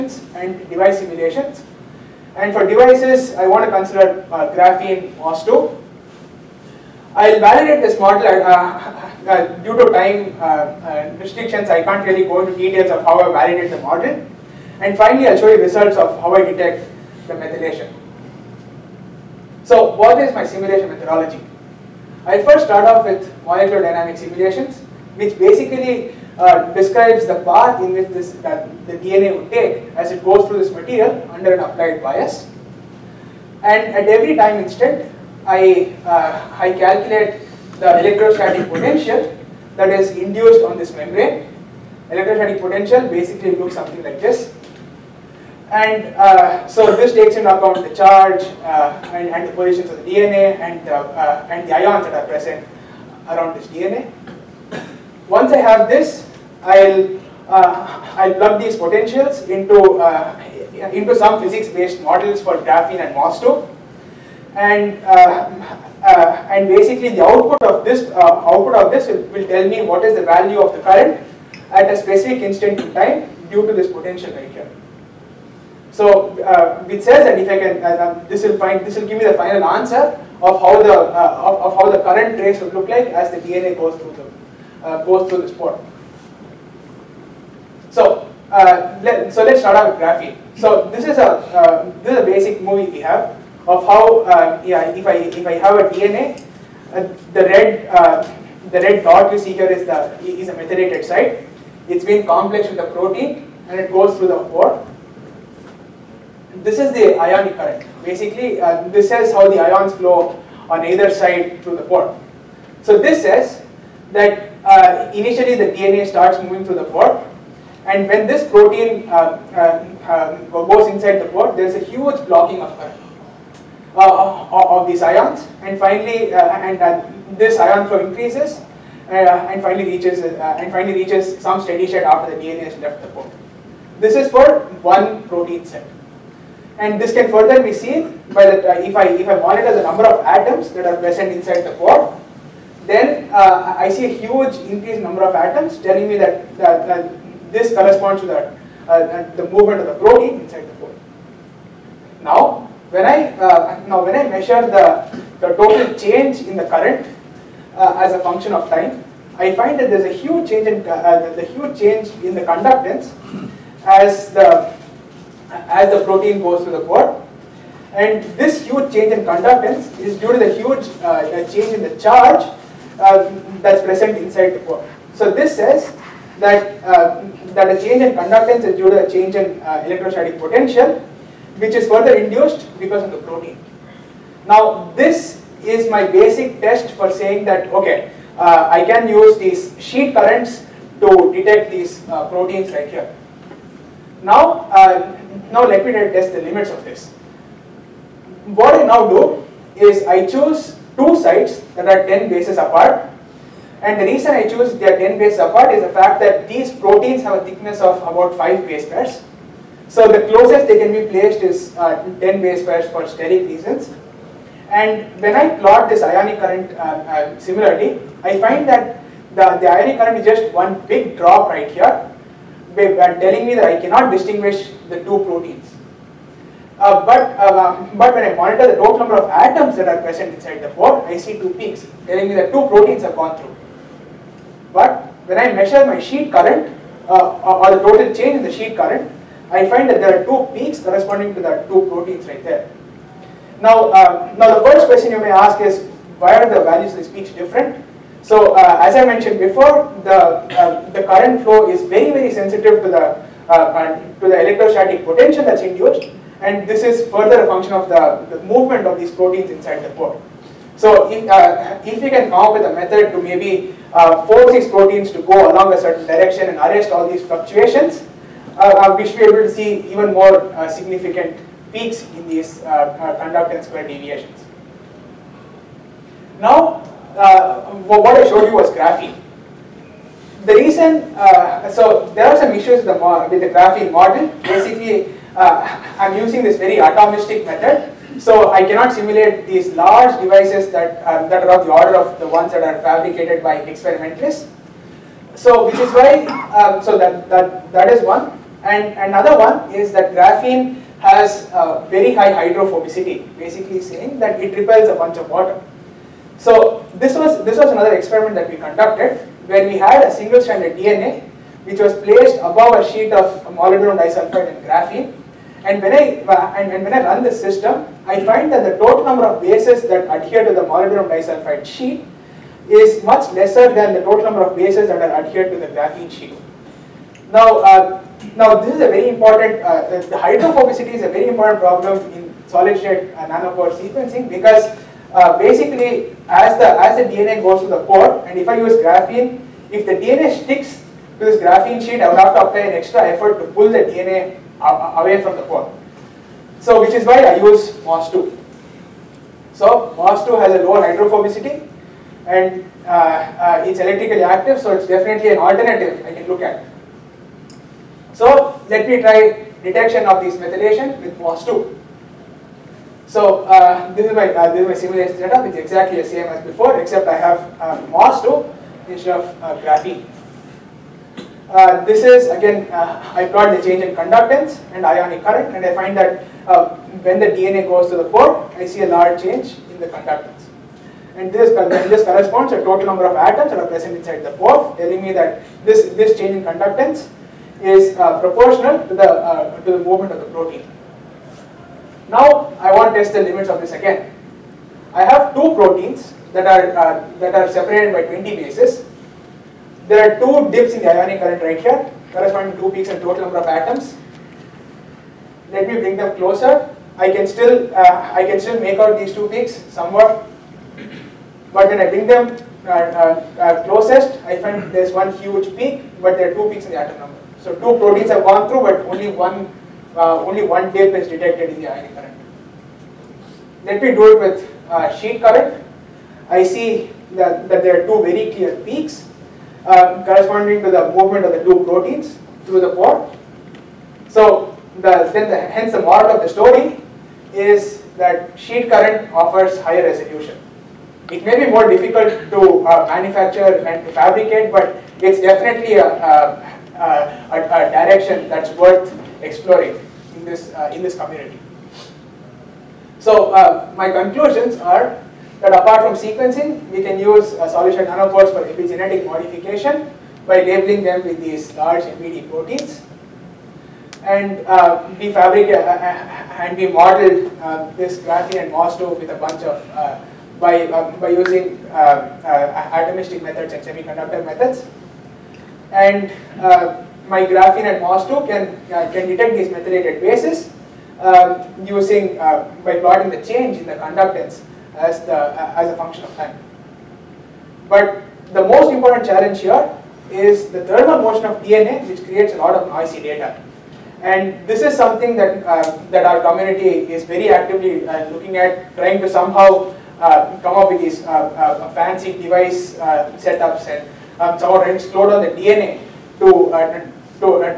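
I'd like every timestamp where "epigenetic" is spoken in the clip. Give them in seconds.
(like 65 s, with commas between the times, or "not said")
458 s.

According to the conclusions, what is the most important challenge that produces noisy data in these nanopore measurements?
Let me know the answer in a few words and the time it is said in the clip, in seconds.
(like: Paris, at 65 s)
Thermal motion of DNA, at 490 s.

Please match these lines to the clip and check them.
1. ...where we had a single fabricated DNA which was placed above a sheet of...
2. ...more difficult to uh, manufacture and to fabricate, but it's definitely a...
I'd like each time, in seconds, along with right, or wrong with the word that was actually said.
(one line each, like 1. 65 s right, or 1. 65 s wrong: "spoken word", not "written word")
1. 309 s wrong: "stranded", not "fabricated"
2. 441 s right.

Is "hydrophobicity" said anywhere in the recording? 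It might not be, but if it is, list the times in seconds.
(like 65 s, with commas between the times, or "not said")
302 s, 330 s, 350 s.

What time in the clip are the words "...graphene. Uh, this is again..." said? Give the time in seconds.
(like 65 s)
369 s.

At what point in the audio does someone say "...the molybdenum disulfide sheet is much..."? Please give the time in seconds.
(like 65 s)
320 s.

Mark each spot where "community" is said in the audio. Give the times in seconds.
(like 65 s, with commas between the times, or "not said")
450 s, 496 s.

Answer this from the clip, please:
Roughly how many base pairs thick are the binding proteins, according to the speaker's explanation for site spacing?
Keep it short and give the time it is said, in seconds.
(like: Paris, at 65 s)
About 5 base pairs, at 208 s.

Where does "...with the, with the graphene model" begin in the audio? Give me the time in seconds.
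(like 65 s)
282 s.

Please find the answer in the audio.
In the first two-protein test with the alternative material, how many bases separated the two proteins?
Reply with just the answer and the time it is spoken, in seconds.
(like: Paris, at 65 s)
20, at 398 s.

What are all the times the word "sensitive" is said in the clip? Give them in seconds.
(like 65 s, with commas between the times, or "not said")
252 s.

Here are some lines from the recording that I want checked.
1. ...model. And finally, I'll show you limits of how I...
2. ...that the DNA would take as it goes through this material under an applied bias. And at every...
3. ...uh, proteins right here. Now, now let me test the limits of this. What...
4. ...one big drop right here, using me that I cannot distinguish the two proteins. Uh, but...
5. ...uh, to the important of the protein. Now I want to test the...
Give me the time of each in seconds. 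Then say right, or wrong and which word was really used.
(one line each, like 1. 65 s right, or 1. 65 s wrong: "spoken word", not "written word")
1. 13 s wrong: "results", not "limits"
2. 28 s right
3. 192 s right
4. 220 s wrong: "telling", not "using"
5. 389 s wrong: "movement", not "important".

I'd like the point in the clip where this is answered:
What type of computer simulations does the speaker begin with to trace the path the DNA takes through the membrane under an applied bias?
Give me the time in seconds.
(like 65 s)
23 s.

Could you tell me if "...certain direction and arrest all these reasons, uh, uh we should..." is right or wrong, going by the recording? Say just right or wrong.
wrong.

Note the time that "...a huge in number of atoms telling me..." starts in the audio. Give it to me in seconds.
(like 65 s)
144 s.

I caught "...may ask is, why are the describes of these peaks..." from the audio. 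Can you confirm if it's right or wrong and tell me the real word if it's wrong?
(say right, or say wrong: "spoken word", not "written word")
wrong: "values", not "describes".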